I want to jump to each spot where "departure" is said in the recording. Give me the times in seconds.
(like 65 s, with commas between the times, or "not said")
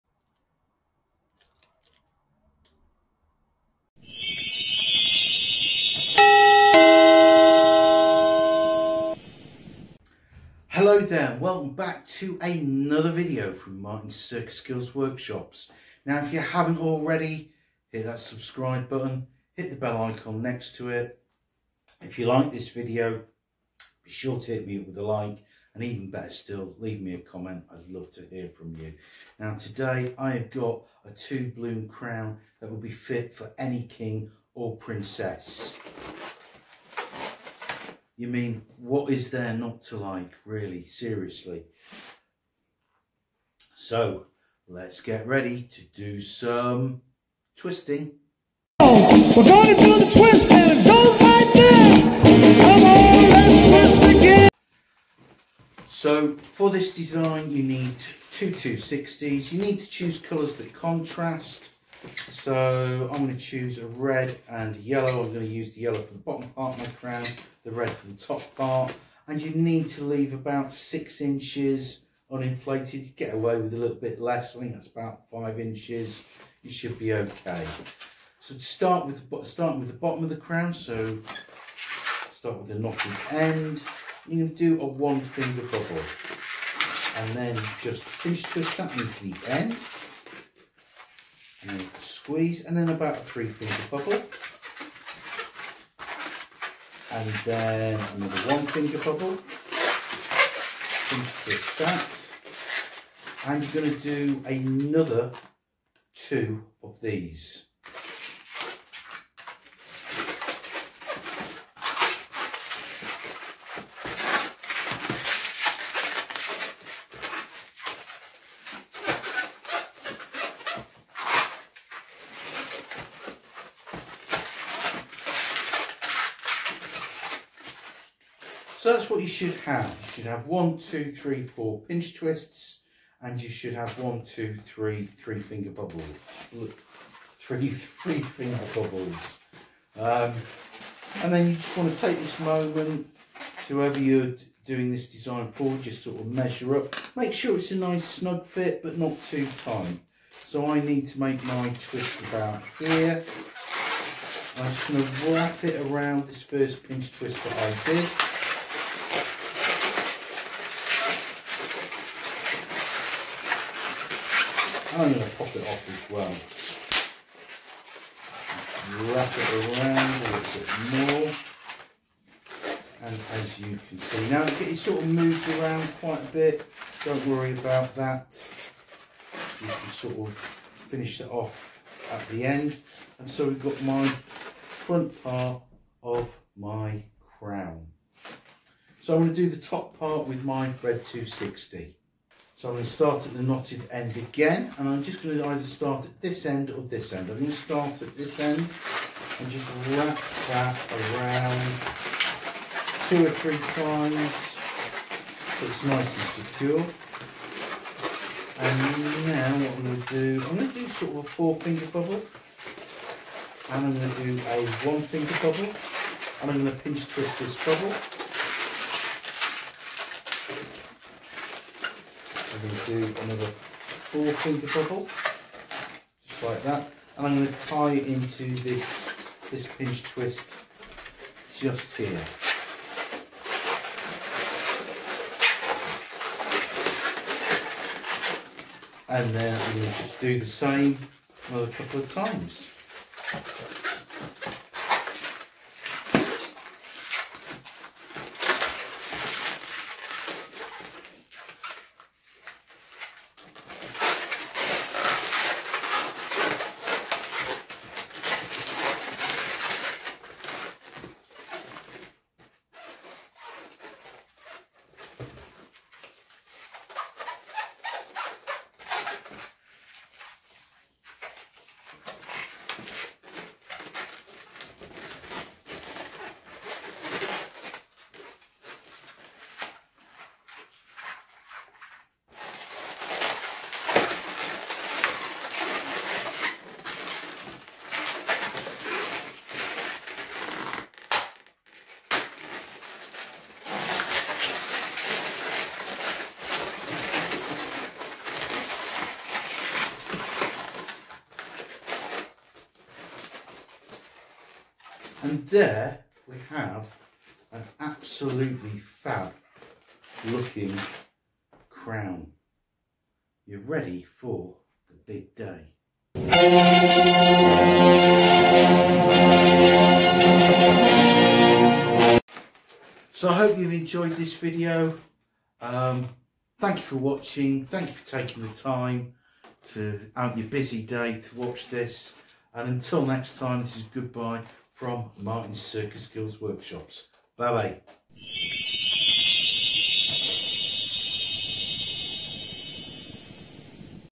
not said.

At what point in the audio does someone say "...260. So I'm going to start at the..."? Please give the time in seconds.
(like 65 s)
191 s.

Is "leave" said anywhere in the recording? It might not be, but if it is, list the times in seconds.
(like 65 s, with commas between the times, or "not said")
26 s, 70 s.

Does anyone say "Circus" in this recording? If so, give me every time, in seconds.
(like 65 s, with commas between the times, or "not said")
14 s, 335 s.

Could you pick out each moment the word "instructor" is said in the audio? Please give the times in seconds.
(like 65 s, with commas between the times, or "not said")
not said.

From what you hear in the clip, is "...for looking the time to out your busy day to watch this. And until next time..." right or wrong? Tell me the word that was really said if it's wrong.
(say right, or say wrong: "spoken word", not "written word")
wrong: "taking", not "looking".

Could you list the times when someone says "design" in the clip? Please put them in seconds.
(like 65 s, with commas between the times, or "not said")
56 s, 145 s.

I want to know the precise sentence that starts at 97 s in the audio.
And then another one finger bubble.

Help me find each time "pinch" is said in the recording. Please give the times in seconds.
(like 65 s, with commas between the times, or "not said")
88 s, 101 s, 131 s, 156 s, 216 s, 229 s.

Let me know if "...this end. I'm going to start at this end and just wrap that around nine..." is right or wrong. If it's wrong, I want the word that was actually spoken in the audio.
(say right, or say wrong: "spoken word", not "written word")
wrong: "two", not "nine".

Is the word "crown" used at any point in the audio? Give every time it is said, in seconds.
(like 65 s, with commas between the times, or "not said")
31 s, 66 s, 80 s, 187 s, 311 s.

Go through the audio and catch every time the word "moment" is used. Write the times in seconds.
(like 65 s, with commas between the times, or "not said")
142 s.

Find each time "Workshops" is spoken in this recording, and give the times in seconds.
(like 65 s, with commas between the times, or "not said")
14 s, 336 s.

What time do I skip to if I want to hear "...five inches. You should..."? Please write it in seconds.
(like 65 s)
75 s.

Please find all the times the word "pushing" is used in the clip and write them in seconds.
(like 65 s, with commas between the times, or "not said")
not said.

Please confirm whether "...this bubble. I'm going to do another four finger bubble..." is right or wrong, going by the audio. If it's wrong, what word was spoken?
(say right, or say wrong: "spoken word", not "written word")
right.